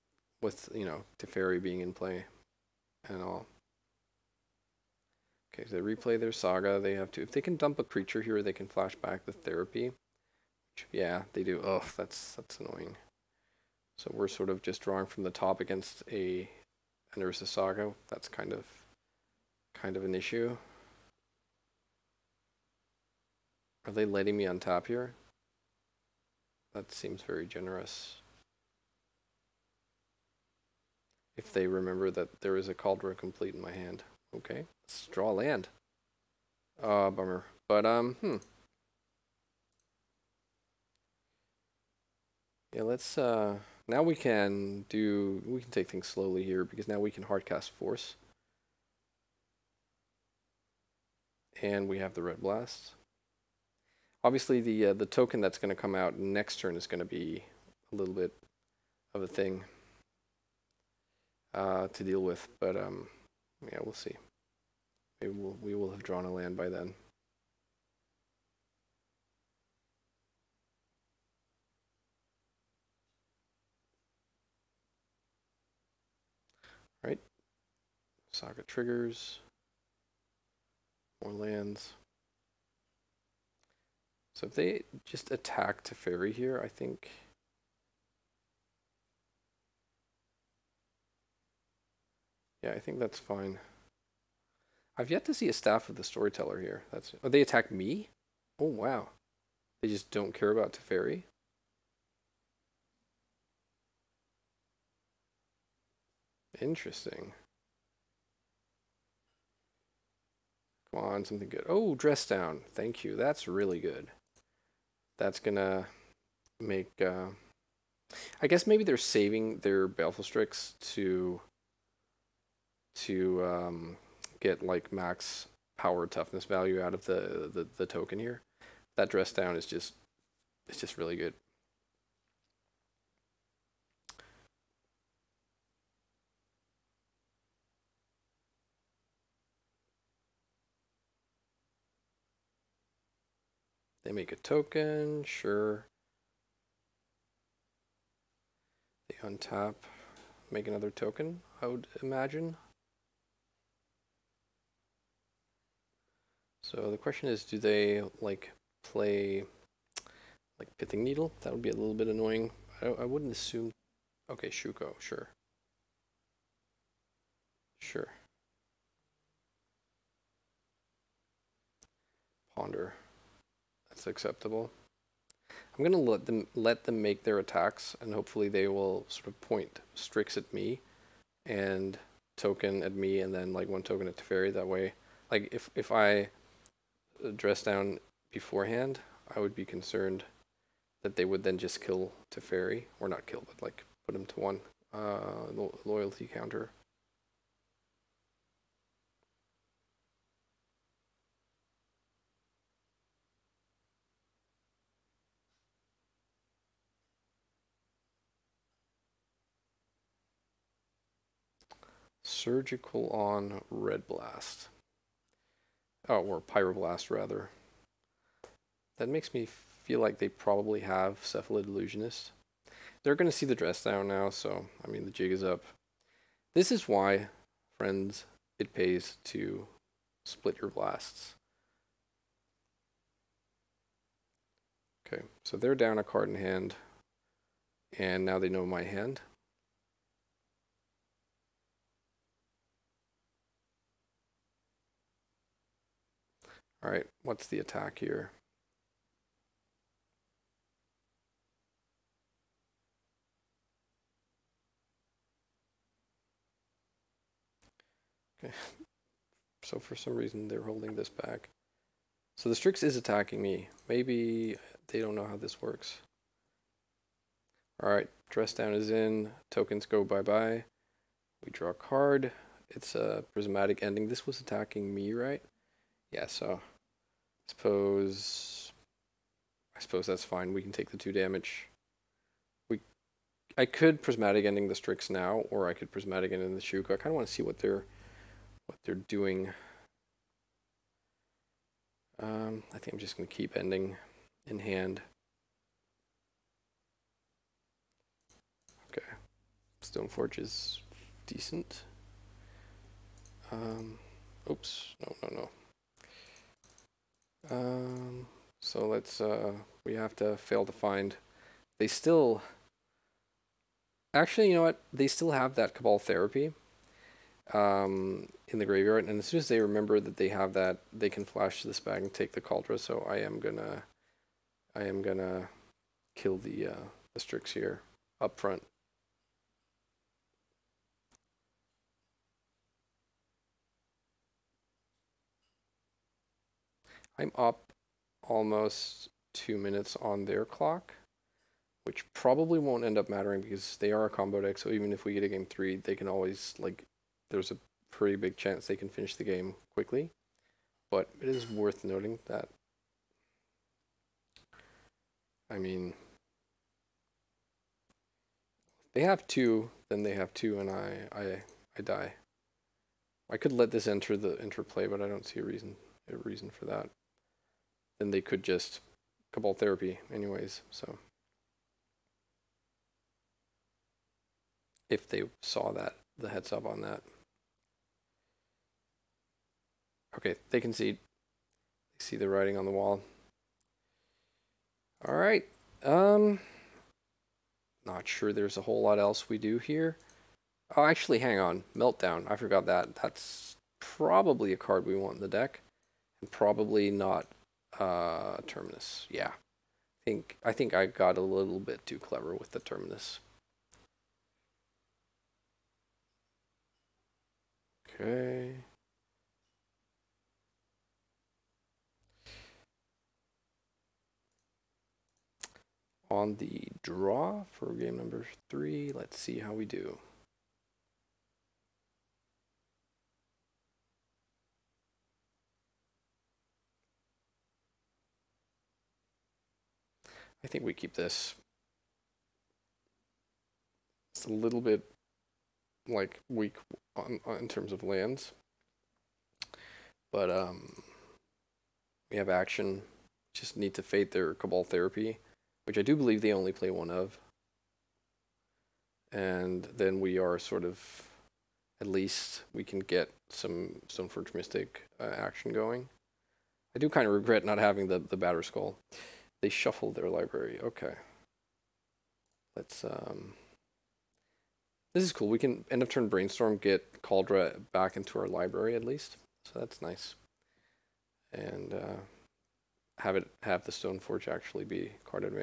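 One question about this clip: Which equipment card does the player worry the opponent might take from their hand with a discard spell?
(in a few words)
Kaldra Compleat.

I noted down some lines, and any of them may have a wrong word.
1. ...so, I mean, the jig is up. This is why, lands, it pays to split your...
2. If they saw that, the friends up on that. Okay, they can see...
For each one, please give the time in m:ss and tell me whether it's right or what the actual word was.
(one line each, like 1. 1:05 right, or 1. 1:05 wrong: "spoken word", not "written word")
1. 3:44 wrong: "friends", not "lands"
2. 6:14 wrong: "heads", not "friends".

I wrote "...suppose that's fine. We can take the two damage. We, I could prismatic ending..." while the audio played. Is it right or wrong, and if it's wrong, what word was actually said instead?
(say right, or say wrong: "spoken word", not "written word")
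right.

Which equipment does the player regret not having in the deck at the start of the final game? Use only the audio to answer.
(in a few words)
Batterskull.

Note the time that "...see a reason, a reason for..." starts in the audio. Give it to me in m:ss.
6:05.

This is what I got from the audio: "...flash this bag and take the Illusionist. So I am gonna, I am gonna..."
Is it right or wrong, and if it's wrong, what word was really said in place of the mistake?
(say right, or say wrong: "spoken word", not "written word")
wrong: "Kaldra", not "Illusionist".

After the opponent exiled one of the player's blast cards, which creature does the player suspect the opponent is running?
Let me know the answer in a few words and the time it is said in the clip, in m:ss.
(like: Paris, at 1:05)
Cephalid Illusionist, at 3:41.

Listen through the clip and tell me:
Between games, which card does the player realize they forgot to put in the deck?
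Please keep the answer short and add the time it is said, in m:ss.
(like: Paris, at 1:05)
Meltdown, at 6:31.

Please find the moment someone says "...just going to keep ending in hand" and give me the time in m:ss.
4:52.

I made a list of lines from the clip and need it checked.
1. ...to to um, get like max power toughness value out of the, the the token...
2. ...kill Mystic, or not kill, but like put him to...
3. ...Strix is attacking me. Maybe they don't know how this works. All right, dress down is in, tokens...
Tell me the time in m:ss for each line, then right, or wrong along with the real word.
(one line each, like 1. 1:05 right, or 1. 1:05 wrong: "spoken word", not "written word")
1. 2:00 right
2. 3:11 wrong: "Teferi", not "Mystic"
3. 4:22 right.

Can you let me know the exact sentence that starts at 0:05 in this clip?
Okay, so they replay their saga.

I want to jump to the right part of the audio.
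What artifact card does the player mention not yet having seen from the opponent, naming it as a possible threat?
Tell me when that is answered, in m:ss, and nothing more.
1:35.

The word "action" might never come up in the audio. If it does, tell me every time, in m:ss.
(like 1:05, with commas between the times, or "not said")
7:22, 7:35.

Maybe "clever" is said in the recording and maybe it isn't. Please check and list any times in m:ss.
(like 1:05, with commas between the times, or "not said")
6:41.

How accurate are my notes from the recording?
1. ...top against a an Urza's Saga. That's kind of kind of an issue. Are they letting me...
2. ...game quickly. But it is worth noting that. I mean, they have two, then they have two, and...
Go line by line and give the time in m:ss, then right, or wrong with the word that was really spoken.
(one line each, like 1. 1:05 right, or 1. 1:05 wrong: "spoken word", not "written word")
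1. 0:15 right
2. 5:49 right.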